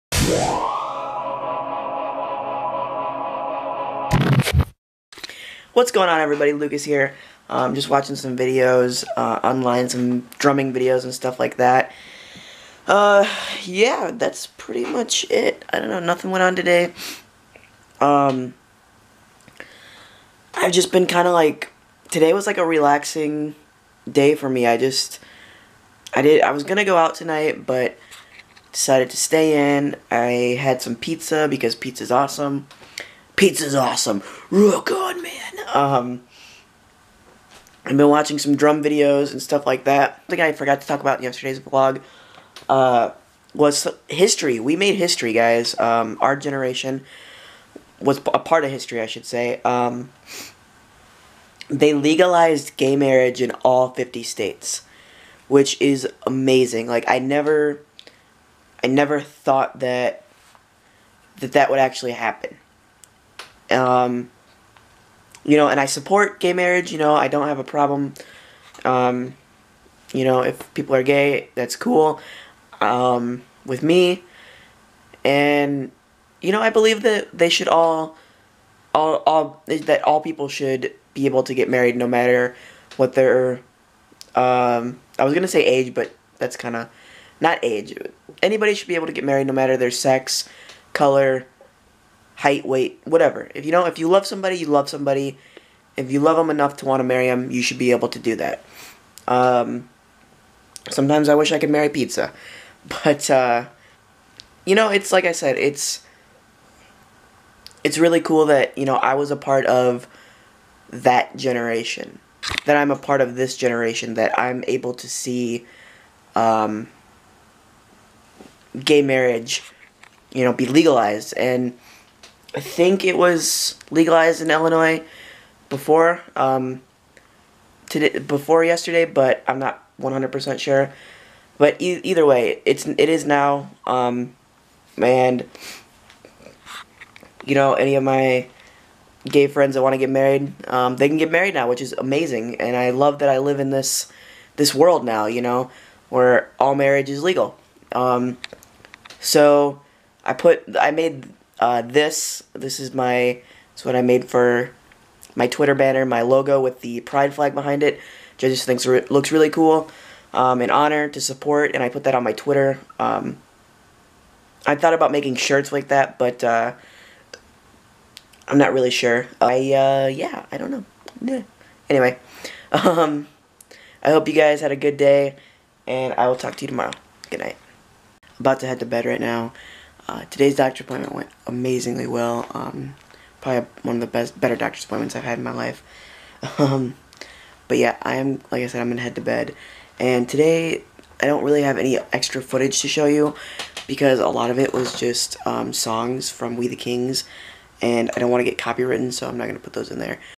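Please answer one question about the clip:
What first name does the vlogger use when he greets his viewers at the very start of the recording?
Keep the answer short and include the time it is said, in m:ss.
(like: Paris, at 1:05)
Lucas, at 0:06.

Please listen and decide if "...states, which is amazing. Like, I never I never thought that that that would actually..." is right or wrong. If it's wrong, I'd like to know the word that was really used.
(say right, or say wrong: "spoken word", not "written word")
right.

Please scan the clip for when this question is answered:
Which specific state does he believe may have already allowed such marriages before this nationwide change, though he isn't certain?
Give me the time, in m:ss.
2:04.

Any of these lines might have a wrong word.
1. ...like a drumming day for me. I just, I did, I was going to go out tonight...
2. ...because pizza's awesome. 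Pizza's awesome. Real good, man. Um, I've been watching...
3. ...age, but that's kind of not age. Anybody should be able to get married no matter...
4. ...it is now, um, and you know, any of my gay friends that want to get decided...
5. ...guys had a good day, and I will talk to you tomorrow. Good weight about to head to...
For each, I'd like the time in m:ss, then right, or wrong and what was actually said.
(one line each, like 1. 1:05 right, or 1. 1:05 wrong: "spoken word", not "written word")
1. 0:22 wrong: "relaxing", not "drumming"
2. 0:31 right
3. 1:25 right
4. 2:12 wrong: "married", not "decided"
5. 2:54 wrong: "night", not "weight".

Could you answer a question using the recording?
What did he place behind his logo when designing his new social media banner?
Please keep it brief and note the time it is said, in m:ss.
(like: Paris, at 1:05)
The pride flag, at 2:37.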